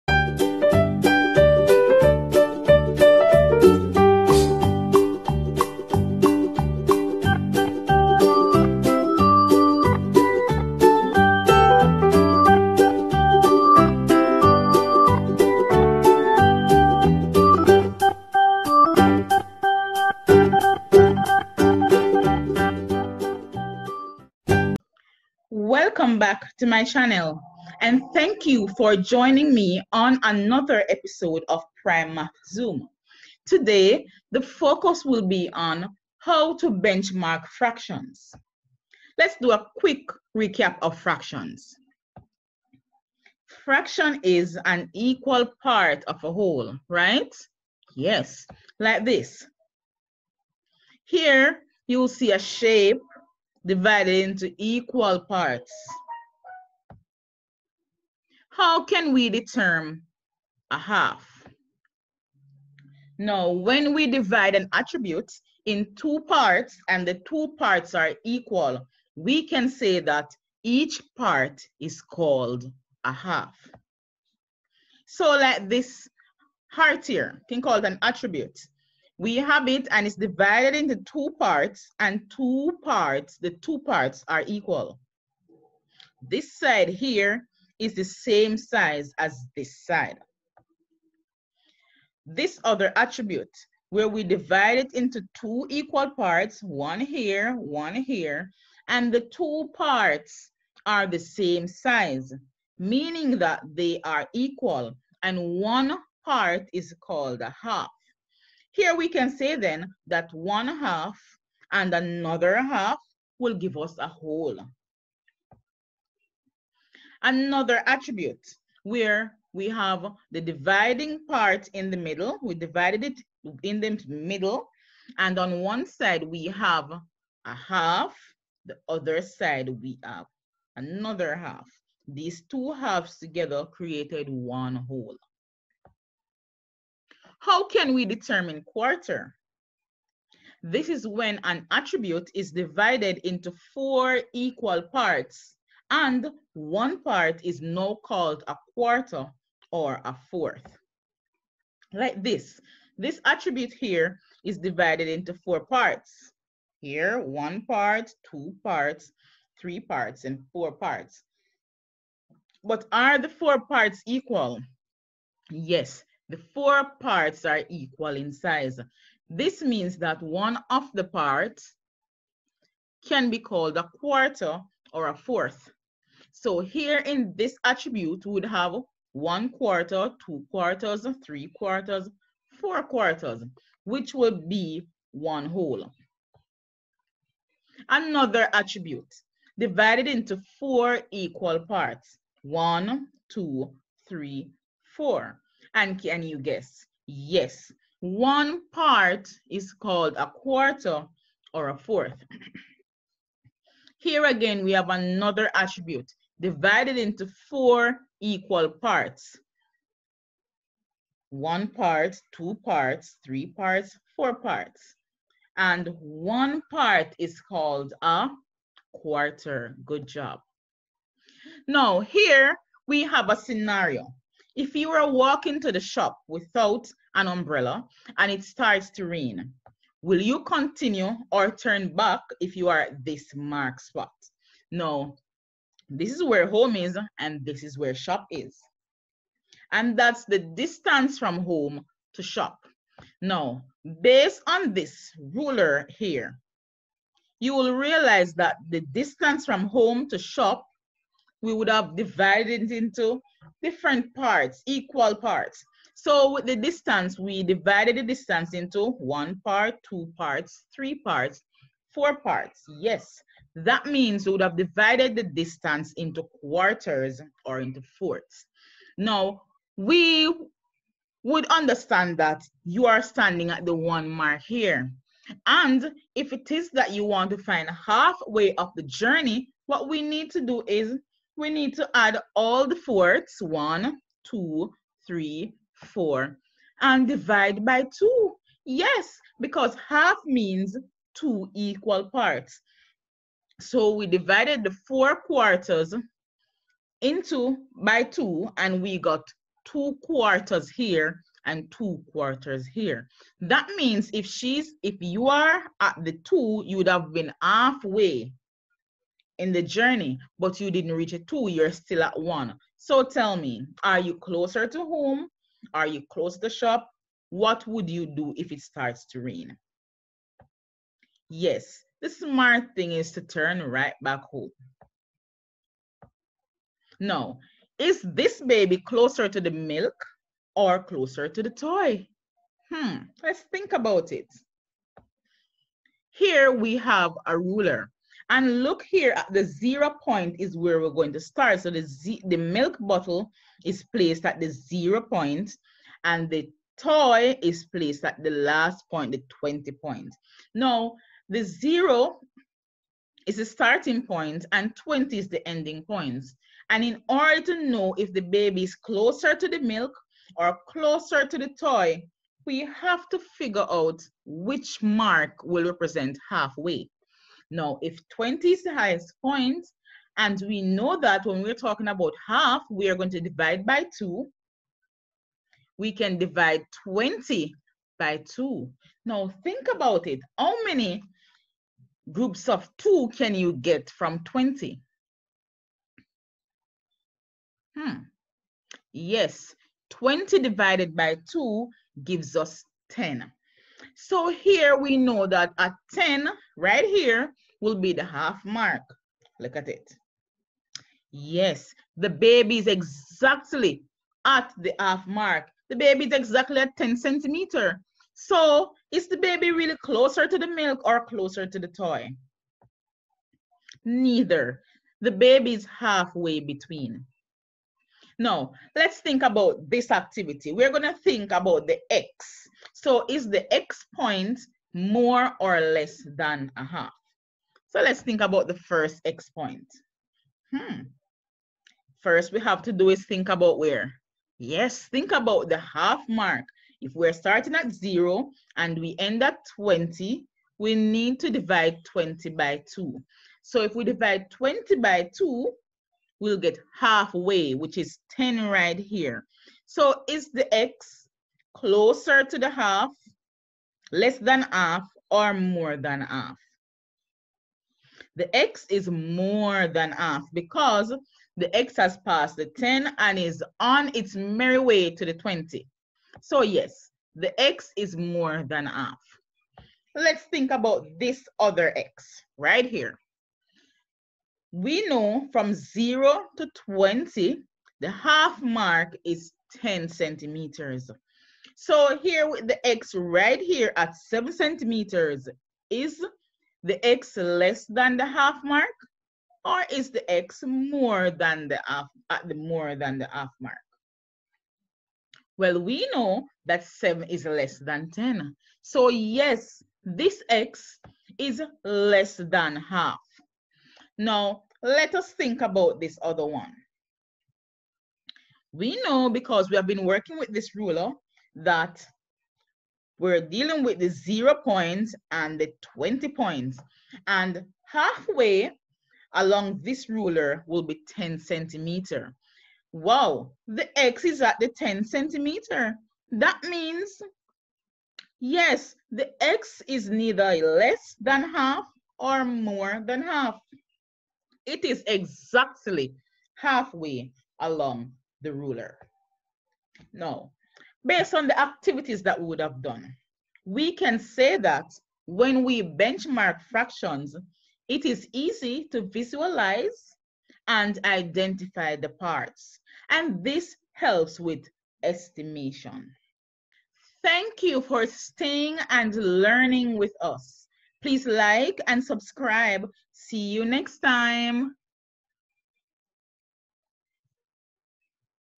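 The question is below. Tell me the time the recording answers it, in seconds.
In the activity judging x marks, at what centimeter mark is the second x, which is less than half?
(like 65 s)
483 s.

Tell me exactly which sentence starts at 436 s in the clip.
If we're starting at zero and we end at 20, we need to divide 20 by two.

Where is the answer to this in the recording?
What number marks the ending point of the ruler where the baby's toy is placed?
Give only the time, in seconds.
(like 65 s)
349 s.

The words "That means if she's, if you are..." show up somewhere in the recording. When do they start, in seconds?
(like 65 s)
303 s.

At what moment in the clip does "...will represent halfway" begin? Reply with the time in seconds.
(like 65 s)
365 s.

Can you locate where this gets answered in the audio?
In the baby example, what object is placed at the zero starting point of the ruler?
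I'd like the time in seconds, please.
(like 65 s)
342 s.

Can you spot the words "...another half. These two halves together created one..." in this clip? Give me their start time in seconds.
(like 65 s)
130 s.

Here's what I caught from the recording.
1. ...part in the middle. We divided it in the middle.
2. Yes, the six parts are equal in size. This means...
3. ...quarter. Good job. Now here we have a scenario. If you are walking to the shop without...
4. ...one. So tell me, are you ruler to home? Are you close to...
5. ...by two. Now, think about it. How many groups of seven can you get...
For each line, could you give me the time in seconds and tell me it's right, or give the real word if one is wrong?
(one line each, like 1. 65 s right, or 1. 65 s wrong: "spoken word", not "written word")
1. 121 s right
2. 165 s wrong: "four", not "six"
3. 218 s right
4. 312 s wrong: "closer", not "ruler"
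5. 377 s wrong: "two", not "seven".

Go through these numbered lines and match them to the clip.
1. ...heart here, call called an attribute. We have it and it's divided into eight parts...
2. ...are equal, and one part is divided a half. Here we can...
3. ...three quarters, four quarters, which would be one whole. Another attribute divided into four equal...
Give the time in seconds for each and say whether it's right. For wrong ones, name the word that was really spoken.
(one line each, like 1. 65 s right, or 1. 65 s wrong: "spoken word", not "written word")
1. 76 s wrong: "two", not "eight"
2. 104 s wrong: "called", not "divided"
3. 181 s right.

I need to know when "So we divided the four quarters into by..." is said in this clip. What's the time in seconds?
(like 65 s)
293 s.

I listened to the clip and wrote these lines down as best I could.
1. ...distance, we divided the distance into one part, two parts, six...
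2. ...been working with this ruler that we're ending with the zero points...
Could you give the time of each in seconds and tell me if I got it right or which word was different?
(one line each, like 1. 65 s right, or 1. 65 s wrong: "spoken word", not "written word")
1. 256 s wrong: "three", not "six"
2. 509 s wrong: "dealing", not "ending".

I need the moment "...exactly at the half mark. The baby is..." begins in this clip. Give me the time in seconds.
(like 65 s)
402 s.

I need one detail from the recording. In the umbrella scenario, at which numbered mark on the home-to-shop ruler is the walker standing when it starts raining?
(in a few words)
1.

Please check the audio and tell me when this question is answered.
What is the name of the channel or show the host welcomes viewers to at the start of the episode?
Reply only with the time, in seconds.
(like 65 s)
31 s.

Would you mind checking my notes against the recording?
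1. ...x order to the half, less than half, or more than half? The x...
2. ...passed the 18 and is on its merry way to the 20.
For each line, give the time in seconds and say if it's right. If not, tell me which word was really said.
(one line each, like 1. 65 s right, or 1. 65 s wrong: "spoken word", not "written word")
1. 450 s wrong: "closer", not "order"
2. 461 s wrong: "10", not "18".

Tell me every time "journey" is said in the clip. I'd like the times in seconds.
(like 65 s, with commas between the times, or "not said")
278 s, 309 s.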